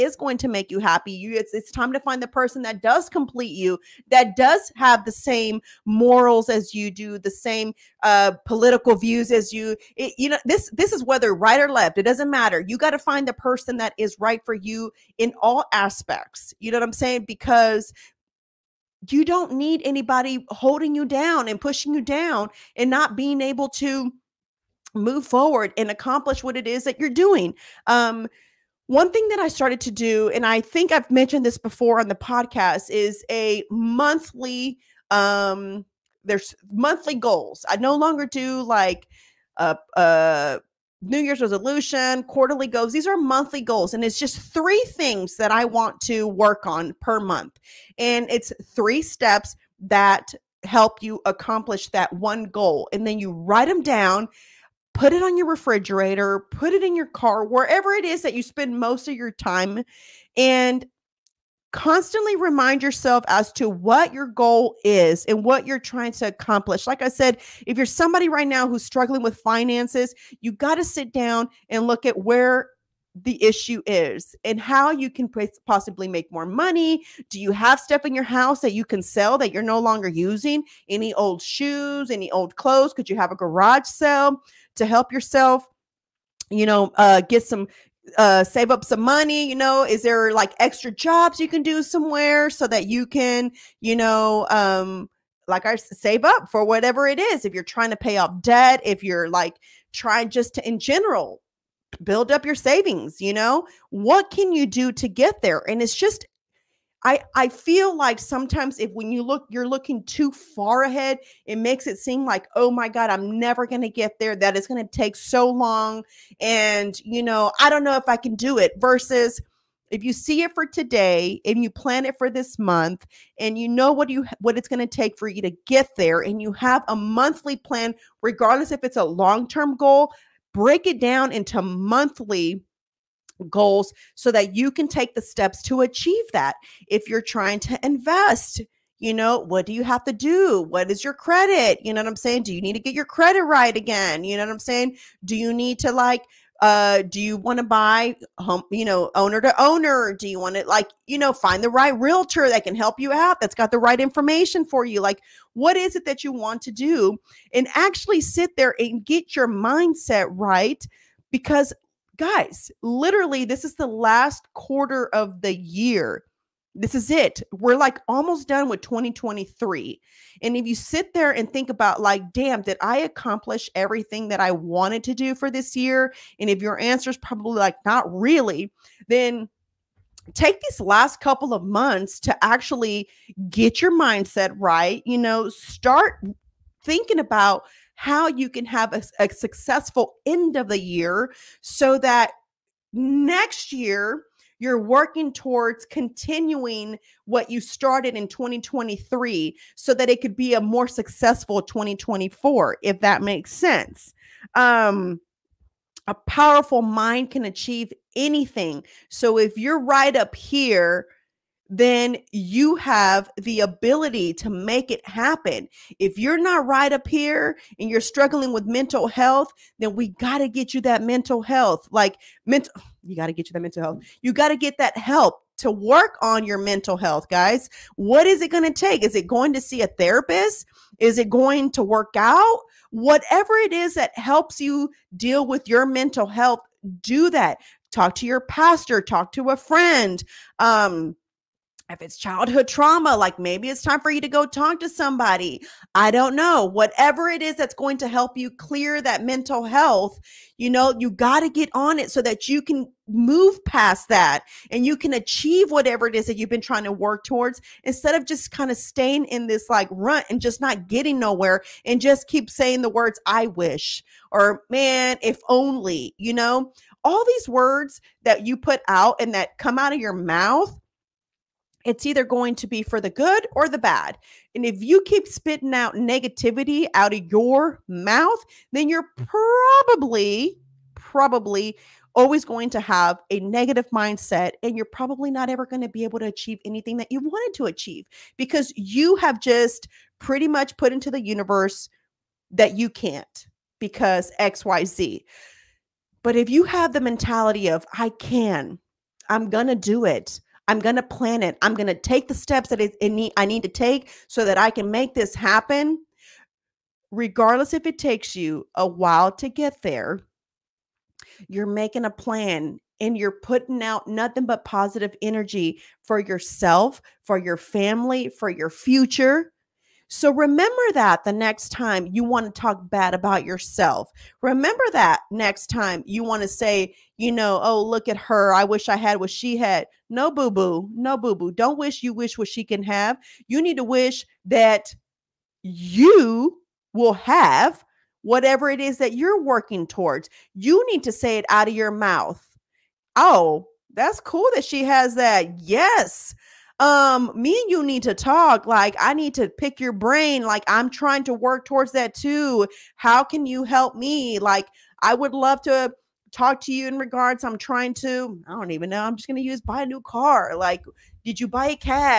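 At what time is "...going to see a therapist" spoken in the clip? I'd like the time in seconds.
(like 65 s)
229 s.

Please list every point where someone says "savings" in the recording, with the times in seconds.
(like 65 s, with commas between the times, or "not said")
102 s.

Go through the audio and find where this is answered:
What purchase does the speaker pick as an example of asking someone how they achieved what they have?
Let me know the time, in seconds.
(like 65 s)
359 s.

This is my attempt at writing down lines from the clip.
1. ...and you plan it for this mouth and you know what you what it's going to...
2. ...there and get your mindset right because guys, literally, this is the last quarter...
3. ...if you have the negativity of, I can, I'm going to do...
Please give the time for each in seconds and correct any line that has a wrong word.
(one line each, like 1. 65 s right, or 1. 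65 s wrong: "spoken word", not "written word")
1. 121 s wrong: "month", not "mouth"
2. 158 s right
3. 296 s wrong: "mentality", not "negativity".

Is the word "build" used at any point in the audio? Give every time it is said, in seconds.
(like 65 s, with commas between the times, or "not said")
102 s.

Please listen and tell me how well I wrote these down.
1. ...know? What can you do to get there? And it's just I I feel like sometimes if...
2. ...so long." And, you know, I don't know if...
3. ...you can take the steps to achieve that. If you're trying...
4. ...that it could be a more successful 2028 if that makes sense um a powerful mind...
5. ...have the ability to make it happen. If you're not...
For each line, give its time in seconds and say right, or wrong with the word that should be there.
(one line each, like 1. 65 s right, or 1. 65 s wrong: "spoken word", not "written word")
1. 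103 s right
2. 115 s right
3. 134 s right
4. 199 s wrong: "2024", not "2028"
5. 212 s right.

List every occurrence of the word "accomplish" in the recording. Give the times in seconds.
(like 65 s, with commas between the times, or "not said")
25 s, 51 s, 66 s, 172 s.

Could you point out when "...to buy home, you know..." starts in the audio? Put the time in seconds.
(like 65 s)
147 s.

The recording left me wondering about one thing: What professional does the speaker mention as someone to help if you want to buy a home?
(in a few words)
realtor.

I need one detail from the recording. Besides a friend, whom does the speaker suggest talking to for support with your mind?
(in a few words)
pastor.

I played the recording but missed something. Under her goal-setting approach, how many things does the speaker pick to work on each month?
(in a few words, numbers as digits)
3.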